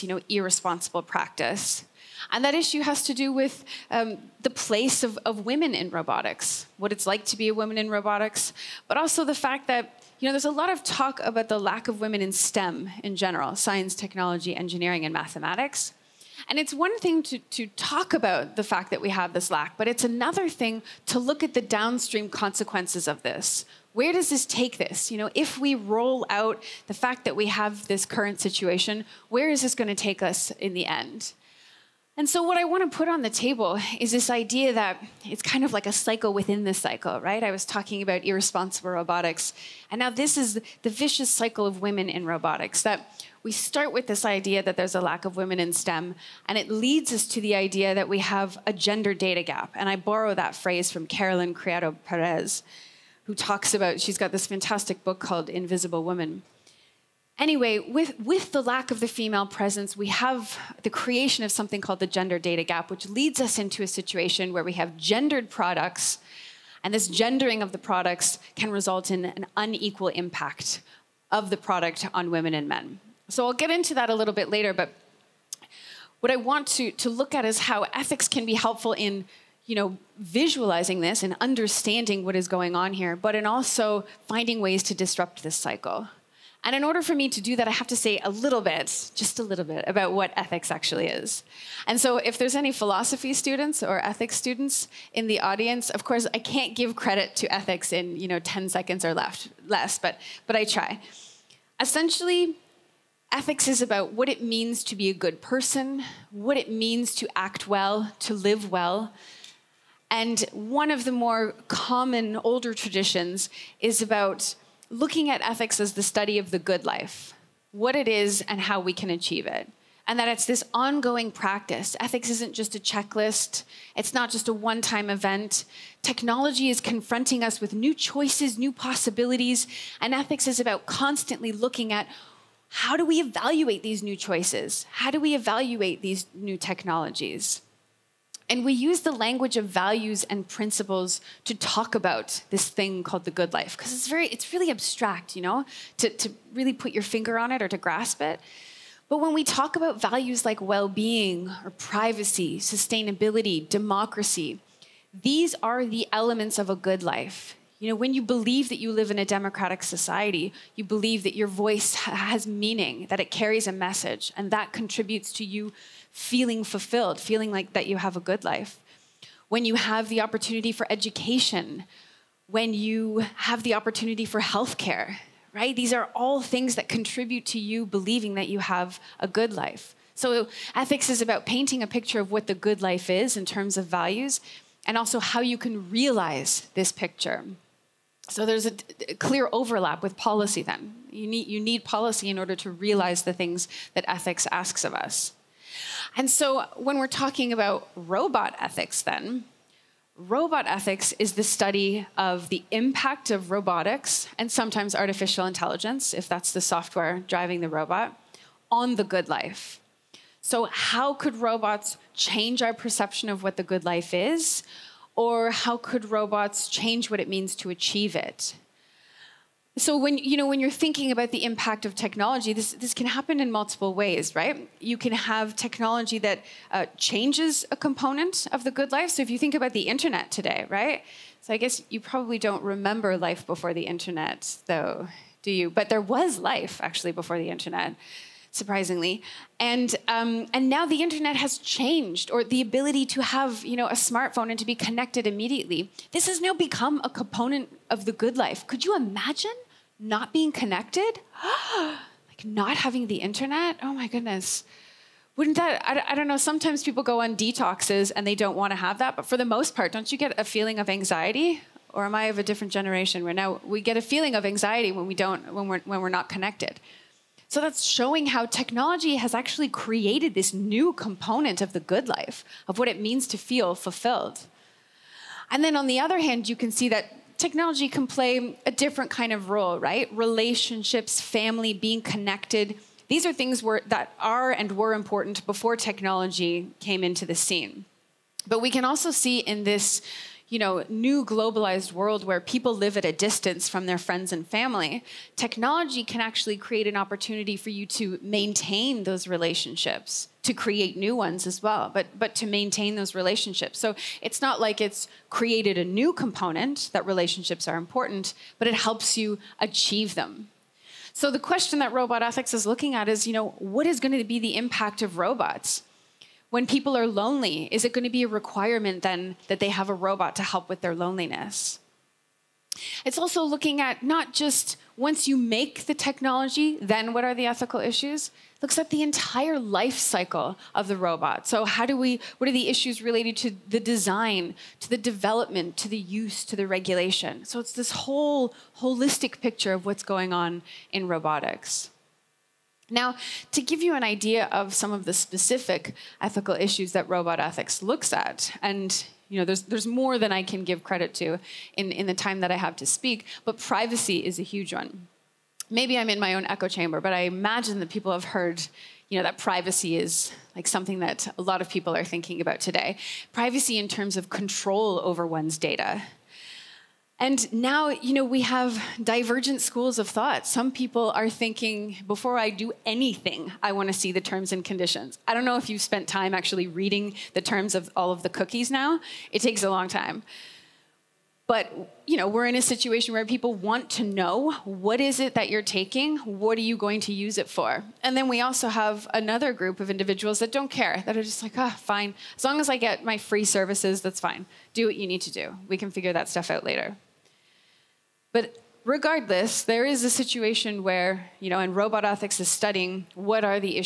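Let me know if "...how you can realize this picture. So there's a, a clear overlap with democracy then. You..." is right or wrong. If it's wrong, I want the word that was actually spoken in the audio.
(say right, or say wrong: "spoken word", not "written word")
wrong: "policy", not "democracy".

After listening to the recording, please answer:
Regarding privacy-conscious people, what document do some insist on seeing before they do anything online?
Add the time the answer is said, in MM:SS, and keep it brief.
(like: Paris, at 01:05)
terms and conditions, at 06:14.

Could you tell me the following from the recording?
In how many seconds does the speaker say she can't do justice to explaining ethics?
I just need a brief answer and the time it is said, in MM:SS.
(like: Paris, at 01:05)
10, at 01:38.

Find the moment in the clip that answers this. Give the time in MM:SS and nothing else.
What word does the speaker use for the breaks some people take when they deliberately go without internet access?
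04:17.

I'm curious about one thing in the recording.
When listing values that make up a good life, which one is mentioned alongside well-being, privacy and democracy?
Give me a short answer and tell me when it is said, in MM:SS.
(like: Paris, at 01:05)
sustainability, at 02:32.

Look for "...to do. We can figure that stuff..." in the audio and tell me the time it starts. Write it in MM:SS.
06:35.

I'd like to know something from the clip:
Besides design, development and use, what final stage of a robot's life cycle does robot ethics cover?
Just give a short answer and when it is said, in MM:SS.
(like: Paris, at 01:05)
regulation, at 05:36.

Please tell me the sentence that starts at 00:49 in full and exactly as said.
And I borrow that phrase from Caroline Criado Perez, who talks about, she's got this fantastic book called Invisible Women.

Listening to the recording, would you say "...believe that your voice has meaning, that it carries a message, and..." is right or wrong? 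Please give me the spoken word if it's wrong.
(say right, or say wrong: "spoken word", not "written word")
right.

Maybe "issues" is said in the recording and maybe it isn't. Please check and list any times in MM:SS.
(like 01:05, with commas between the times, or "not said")
00:02, 05:27, 05:32, 05:46.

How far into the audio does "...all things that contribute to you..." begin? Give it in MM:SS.
02:56.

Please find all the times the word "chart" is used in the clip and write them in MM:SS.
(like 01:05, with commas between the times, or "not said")
not said.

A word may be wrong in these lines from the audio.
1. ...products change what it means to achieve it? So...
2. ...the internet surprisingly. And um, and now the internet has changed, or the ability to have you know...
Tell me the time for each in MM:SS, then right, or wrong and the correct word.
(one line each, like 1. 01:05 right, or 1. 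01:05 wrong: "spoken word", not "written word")
1. 03:36 wrong: "robots", not "products"
2. 03:57 right.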